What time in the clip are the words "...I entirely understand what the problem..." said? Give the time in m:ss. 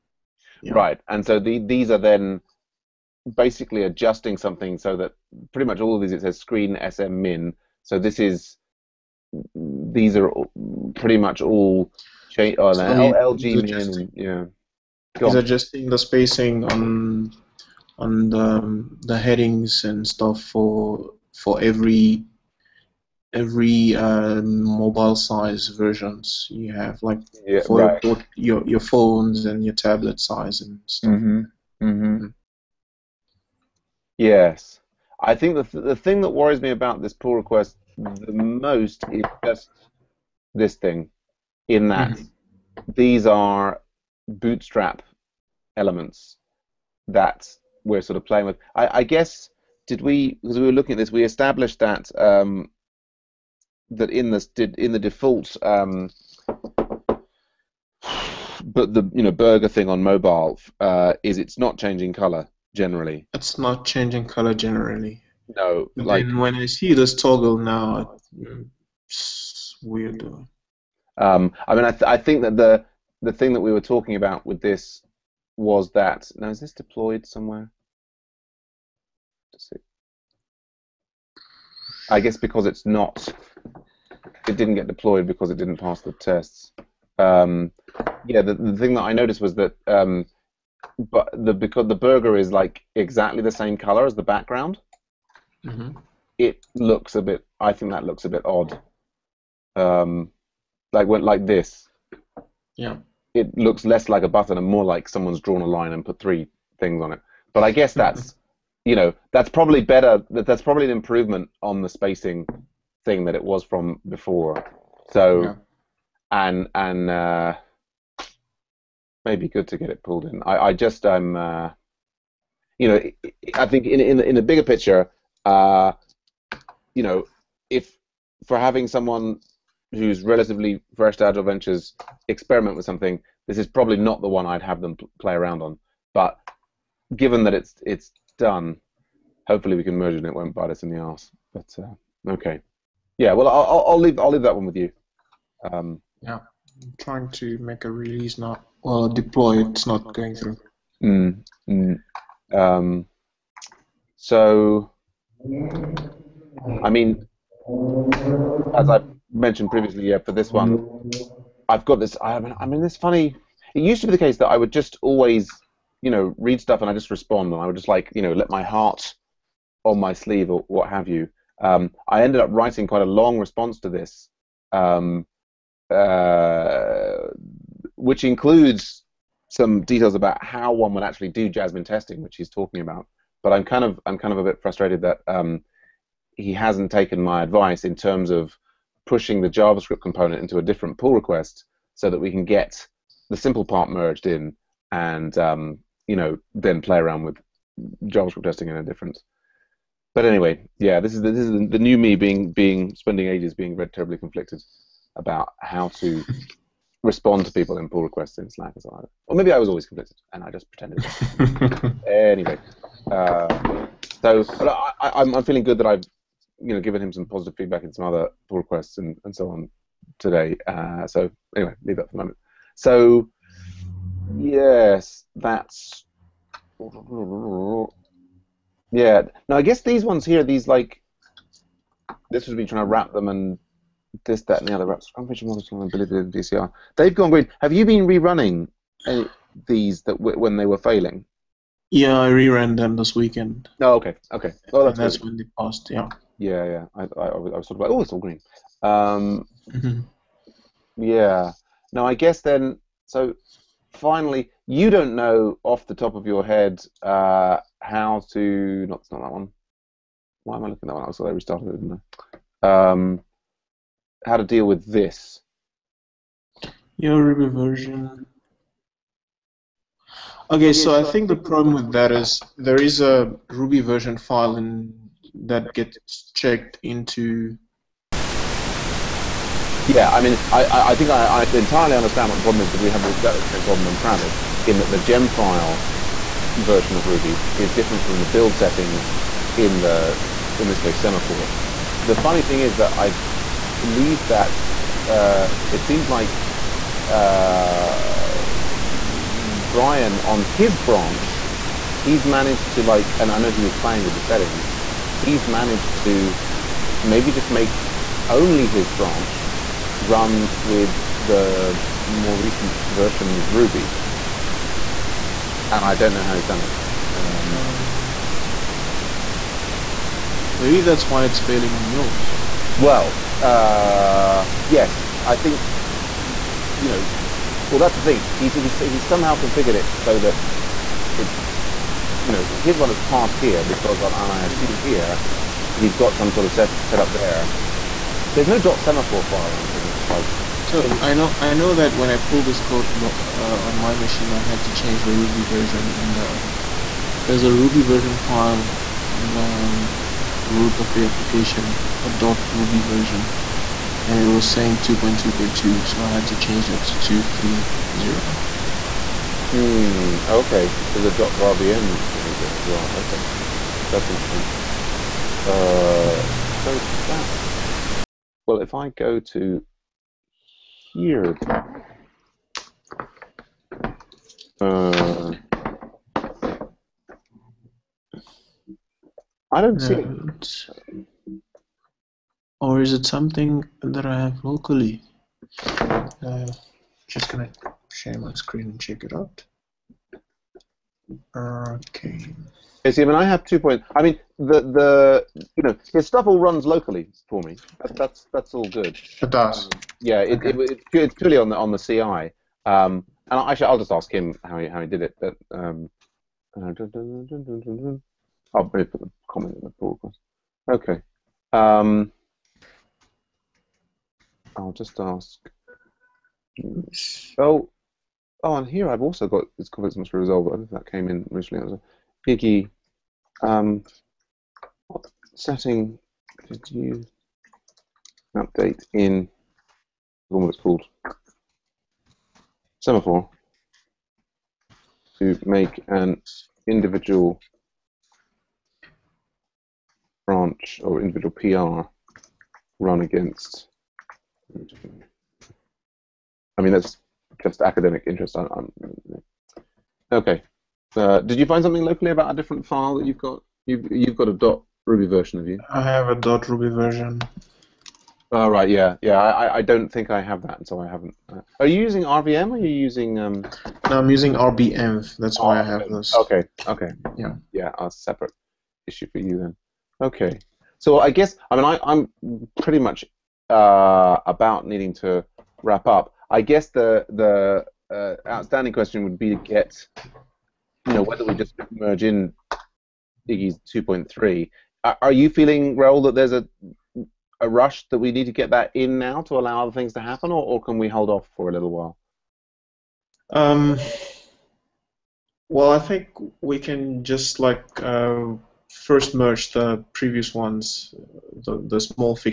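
4:41.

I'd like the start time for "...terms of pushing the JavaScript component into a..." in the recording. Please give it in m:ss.
3:07.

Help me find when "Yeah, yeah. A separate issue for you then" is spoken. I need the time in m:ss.
7:47.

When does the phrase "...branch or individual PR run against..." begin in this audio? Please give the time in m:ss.
7:20.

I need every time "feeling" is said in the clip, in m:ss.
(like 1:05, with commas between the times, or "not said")
3:35, 8:05.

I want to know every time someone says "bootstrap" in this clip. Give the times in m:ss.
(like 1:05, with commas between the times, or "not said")
0:44.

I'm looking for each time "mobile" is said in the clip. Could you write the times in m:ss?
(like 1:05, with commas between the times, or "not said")
0:24, 1:00.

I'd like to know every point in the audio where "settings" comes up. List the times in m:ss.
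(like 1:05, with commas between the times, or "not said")
4:48, 5:04, 7:05.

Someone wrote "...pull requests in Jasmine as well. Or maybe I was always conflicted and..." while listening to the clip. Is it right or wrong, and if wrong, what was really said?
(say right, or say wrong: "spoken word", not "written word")
wrong: "Slack", not "Jasmine".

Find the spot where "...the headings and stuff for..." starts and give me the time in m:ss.
0:19.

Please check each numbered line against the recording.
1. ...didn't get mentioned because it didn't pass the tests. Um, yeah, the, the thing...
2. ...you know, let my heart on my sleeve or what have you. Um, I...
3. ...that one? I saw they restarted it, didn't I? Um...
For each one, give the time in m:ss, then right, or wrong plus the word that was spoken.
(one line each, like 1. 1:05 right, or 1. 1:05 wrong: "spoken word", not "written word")
1. 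1:24 wrong: "deployed", not "mentioned"
2. 2:48 right
3. 4:20 right.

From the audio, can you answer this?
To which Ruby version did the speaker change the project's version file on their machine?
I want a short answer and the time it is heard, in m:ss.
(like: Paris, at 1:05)
2.3.0, at 5:57.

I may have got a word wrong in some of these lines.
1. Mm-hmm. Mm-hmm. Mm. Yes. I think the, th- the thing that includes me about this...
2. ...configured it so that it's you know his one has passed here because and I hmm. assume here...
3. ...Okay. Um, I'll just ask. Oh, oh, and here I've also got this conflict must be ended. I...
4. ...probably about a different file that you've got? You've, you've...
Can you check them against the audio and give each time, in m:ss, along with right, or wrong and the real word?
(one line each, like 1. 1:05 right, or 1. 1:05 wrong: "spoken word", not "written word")
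1. 0:31 wrong: "worries", not "includes"
2. 5:29 right
3. 6:50 wrong: "resolved", not "ended"
4. 7:31 wrong: "locally", not "probably".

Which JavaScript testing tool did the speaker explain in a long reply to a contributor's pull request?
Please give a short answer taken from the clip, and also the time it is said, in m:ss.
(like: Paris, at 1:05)
Jasmine, at 3:01.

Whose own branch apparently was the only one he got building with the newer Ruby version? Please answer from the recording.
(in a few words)
Brian.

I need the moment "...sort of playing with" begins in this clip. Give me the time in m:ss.
0:48.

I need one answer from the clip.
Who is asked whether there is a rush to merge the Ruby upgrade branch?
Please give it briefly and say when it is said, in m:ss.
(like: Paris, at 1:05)
Raoul, at 8:05.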